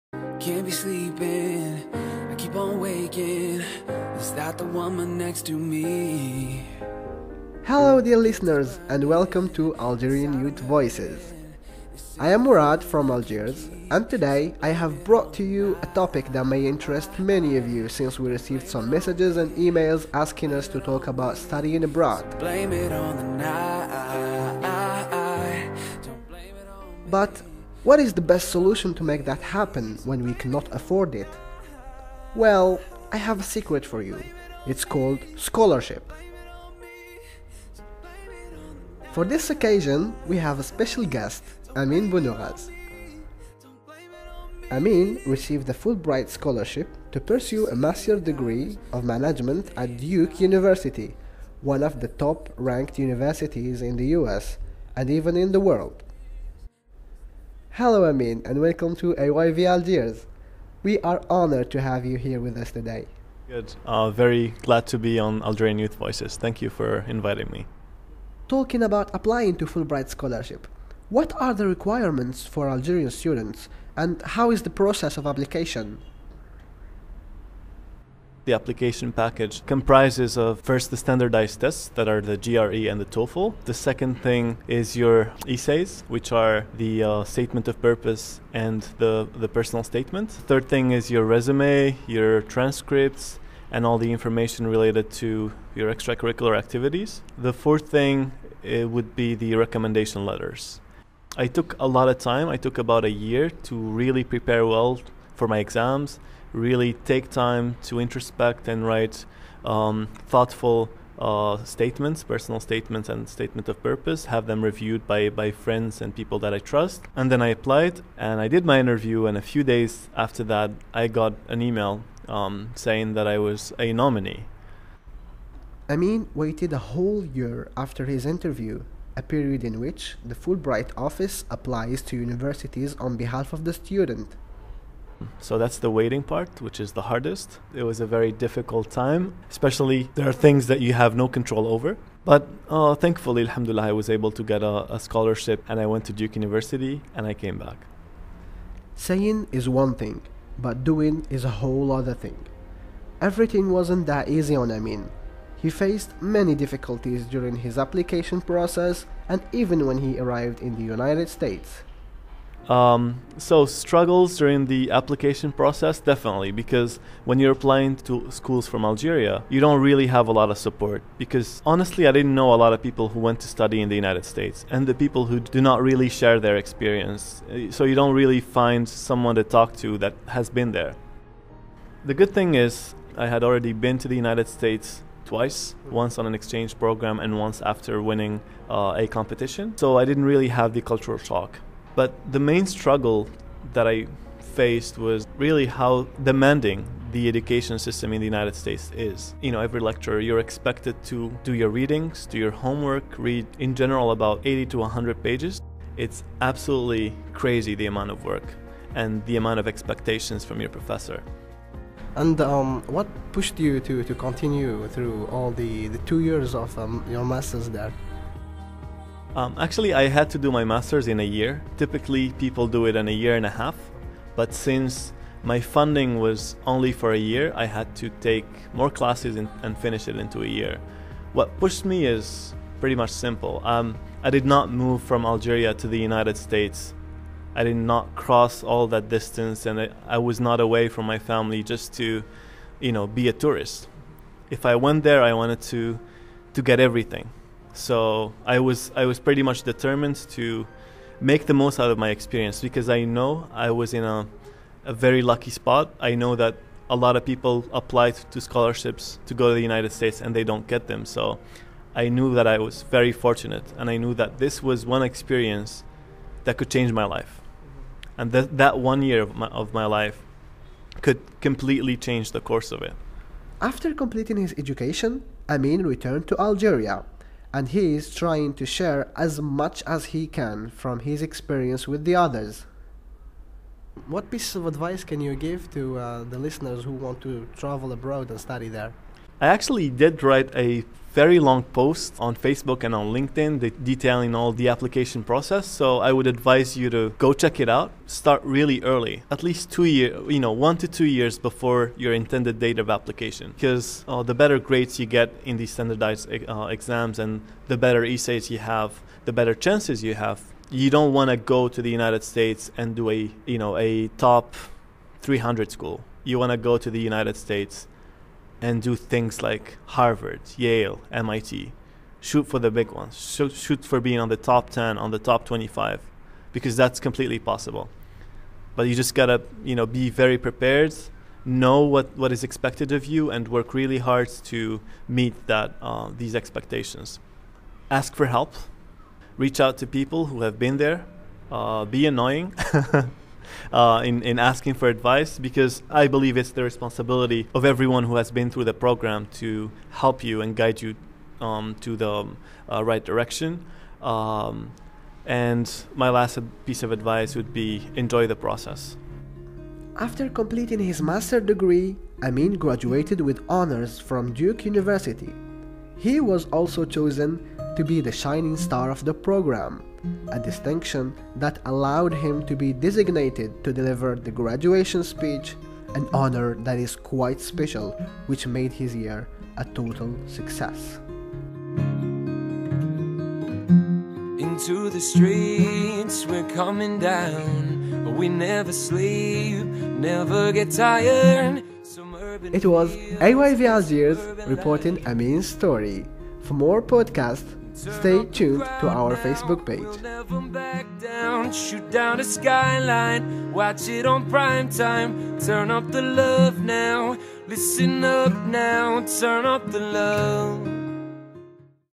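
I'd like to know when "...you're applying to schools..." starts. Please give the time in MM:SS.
02:47.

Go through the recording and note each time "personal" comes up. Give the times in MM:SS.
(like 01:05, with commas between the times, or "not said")
01:29, 01:52.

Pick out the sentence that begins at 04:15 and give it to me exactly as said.
I know that a lot of people apply to scholarships to go to the United States and they don't get them.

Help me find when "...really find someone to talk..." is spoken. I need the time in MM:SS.
02:58.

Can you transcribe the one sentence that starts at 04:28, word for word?
And that that one year of my, of my life could completely change the course of it.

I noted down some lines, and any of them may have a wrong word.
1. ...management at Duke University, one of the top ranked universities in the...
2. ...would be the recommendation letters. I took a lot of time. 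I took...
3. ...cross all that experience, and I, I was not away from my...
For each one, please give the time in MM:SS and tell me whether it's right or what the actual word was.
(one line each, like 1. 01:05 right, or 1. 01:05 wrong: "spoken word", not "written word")
1. 00:49 right
2. 01:38 right
3. 03:58 wrong: "distance", not "experience".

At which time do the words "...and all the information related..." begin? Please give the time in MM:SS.
01:33.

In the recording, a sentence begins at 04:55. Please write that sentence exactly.
So I would advise you to go check it out.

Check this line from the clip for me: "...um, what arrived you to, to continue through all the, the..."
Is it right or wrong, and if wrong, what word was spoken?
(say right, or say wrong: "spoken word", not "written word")
wrong: "pushed", not "arrived".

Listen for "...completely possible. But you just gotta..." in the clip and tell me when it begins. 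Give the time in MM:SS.
05:26.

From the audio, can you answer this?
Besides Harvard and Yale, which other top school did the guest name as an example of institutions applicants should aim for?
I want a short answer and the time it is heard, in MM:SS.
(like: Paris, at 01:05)
MIT, at 05:21.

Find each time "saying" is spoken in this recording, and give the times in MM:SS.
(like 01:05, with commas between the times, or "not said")
02:02, 02:28.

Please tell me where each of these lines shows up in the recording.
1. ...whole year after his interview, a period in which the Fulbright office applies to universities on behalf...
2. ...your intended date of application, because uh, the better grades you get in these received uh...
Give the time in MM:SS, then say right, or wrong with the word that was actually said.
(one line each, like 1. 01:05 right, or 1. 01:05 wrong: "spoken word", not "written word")
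1. 02:06 right
2. 05:01 wrong: "standardized", not "received".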